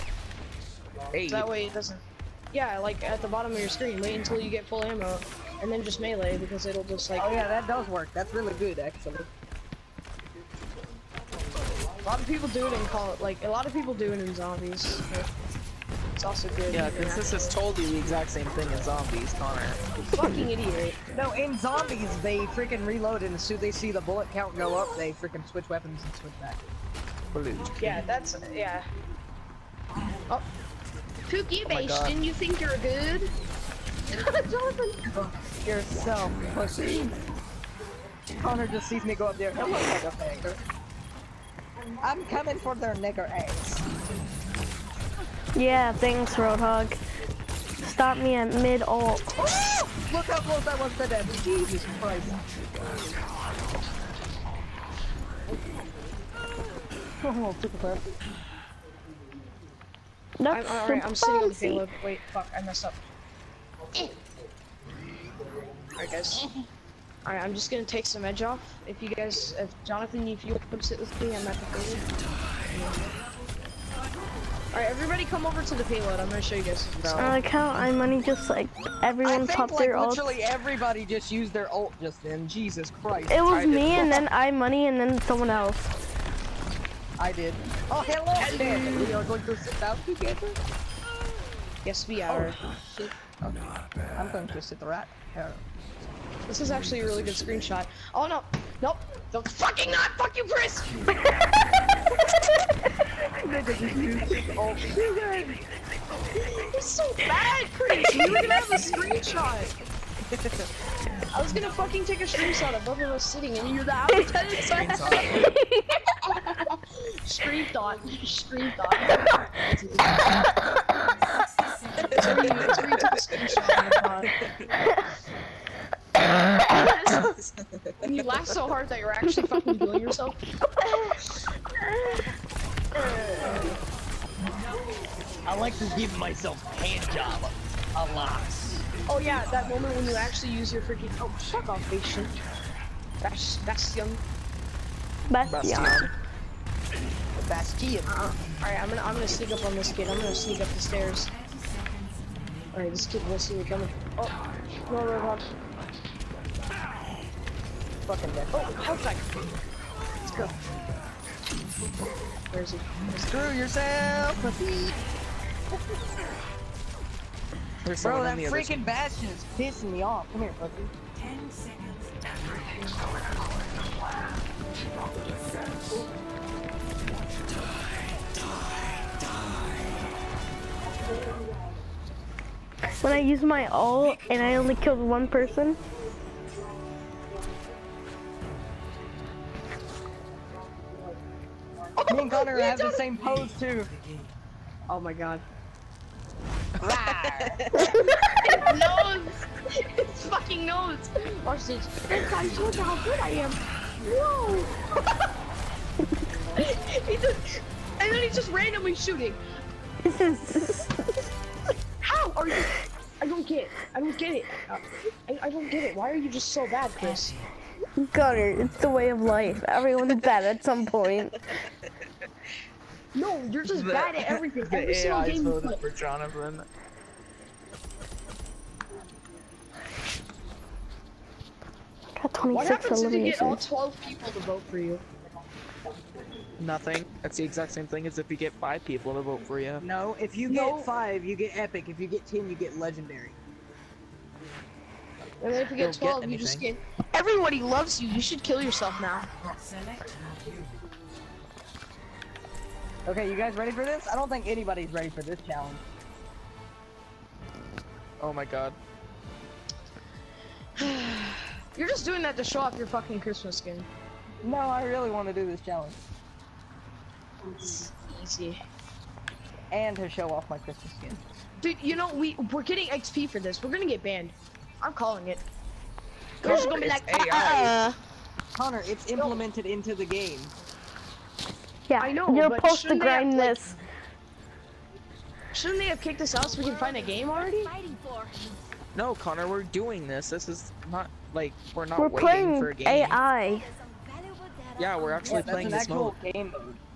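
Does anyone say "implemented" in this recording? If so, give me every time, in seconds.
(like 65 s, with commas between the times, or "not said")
279 s.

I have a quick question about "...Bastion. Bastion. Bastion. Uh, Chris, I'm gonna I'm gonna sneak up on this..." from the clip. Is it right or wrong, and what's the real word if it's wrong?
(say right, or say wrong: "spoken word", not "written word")
wrong: "Alright", not "Chris".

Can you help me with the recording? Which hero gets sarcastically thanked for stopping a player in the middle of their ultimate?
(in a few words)
Roadhog.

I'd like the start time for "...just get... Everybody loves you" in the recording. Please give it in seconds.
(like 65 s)
246 s.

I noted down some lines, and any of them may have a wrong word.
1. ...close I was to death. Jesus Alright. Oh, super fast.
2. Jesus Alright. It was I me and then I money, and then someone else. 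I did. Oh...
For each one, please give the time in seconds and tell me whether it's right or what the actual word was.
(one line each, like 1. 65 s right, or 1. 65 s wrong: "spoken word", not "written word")
1. 50 s wrong: "Christ", not "Alright"
2. 82 s wrong: "Christ", not "Alright".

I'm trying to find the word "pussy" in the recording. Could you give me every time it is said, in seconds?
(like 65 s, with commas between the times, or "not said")
36 s, 164 s.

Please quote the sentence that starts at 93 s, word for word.
Oh, I'm going to sit the here.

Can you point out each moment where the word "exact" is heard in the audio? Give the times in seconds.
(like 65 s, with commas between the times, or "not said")
17 s, 237 s.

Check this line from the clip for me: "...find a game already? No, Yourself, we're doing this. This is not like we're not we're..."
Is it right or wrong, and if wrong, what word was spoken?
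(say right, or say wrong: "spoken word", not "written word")
wrong: "Connor", not "Yourself".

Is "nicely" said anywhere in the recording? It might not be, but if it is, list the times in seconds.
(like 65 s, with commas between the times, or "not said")
not said.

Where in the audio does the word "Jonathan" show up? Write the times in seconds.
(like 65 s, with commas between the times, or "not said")
34 s, 69 s, 225 s.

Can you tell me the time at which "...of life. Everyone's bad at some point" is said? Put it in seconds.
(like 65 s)
219 s.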